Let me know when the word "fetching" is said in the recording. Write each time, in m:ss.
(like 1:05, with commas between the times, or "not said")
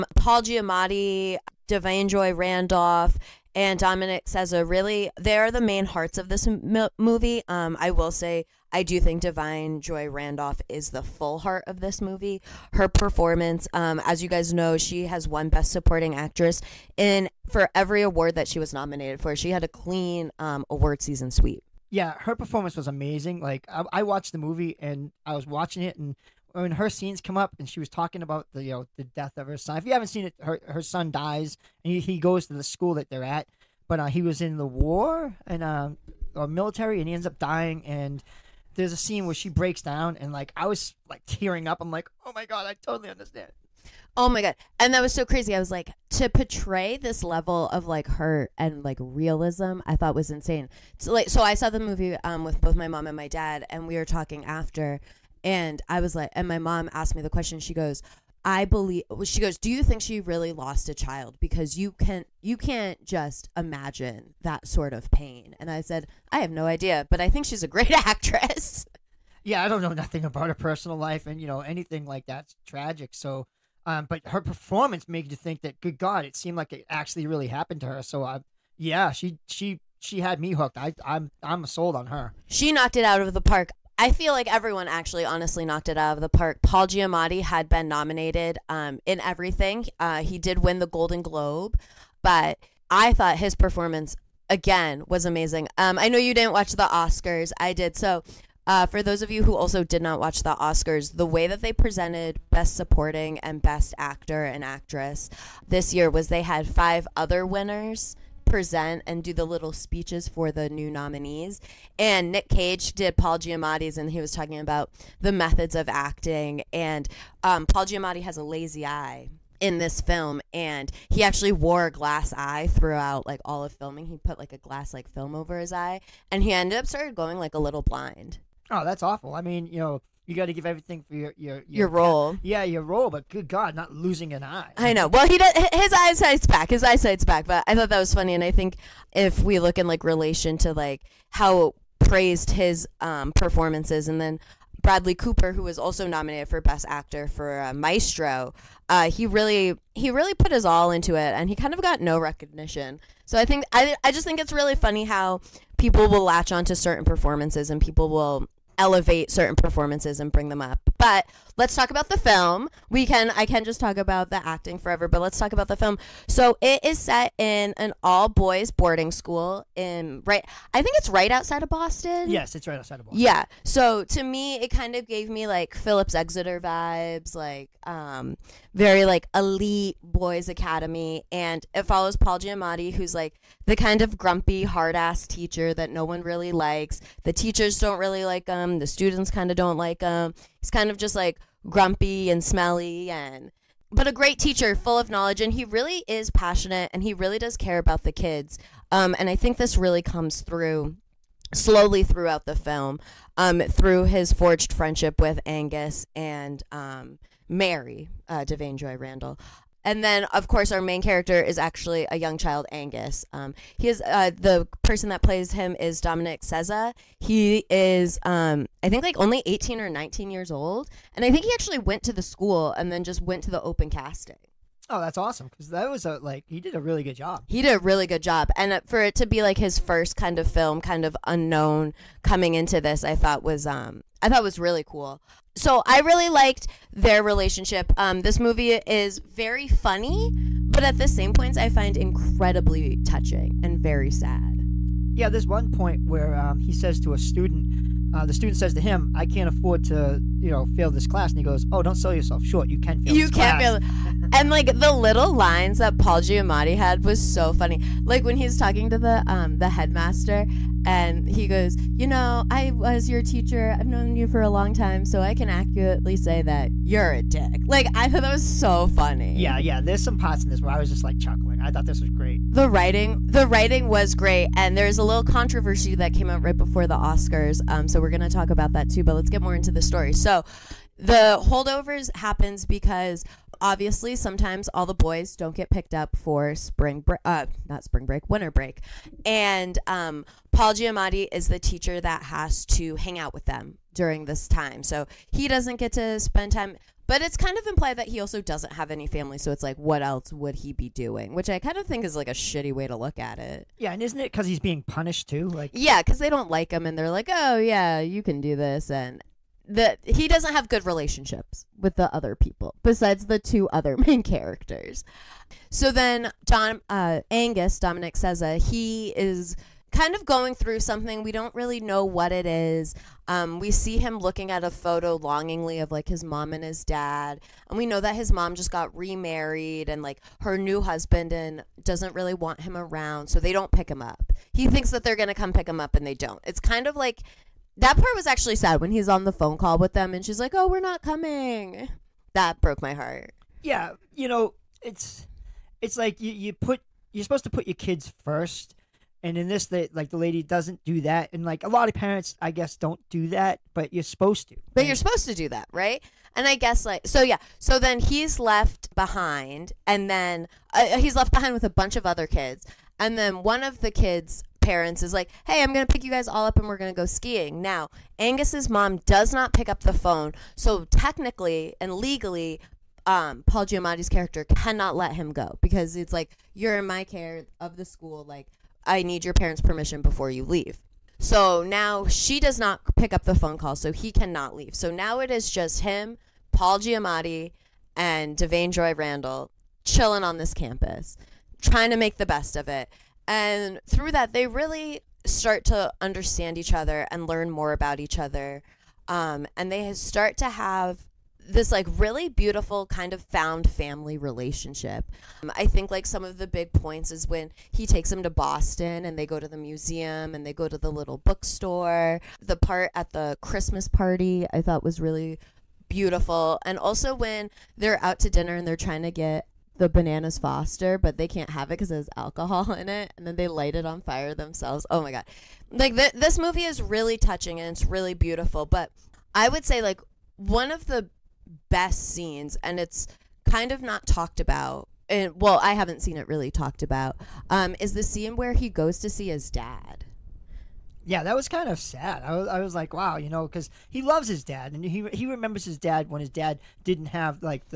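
not said.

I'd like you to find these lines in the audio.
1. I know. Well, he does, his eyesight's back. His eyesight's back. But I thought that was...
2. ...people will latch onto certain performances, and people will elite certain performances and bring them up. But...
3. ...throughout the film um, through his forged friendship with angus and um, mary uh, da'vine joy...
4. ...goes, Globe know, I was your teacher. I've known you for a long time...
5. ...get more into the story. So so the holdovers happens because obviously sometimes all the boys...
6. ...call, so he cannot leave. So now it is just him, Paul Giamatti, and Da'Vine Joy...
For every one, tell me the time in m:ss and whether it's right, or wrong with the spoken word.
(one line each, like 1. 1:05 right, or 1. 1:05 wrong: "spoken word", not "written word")
1. 2:14 right
2. 2:35 wrong: "elevate", not "elite"
3. 3:22 right
4. 4:21 wrong: "You", not "Globe"
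5. 4:39 right
6. 6:23 right.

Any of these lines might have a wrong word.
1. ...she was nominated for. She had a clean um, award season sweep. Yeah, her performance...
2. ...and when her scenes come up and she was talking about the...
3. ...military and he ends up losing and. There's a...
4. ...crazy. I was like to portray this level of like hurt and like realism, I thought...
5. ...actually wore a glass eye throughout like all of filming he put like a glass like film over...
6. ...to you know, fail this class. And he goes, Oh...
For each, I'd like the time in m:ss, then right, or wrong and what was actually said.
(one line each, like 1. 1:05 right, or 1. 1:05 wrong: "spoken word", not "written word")
1. 0:18 right
2. 0:25 right
3. 0:36 wrong: "dying", not "losing"
4. 0:45 right
5. 2:01 right
6. 4:09 right.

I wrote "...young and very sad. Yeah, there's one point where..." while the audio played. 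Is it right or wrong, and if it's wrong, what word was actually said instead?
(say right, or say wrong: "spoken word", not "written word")
wrong: "touching", not "young".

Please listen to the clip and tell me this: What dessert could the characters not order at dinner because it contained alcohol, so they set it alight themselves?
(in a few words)
Bananas Foster.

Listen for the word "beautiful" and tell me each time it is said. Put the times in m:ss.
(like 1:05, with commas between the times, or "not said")
6:42, 6:55, 7:08.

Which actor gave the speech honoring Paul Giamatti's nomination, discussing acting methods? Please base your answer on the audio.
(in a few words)
Nick Cage.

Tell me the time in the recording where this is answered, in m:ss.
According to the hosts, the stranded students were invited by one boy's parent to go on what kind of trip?
6:07.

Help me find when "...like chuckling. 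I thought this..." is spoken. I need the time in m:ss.
4:31.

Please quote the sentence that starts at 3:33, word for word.
Um, he is uh, the person that plays him is Dominic Sessa.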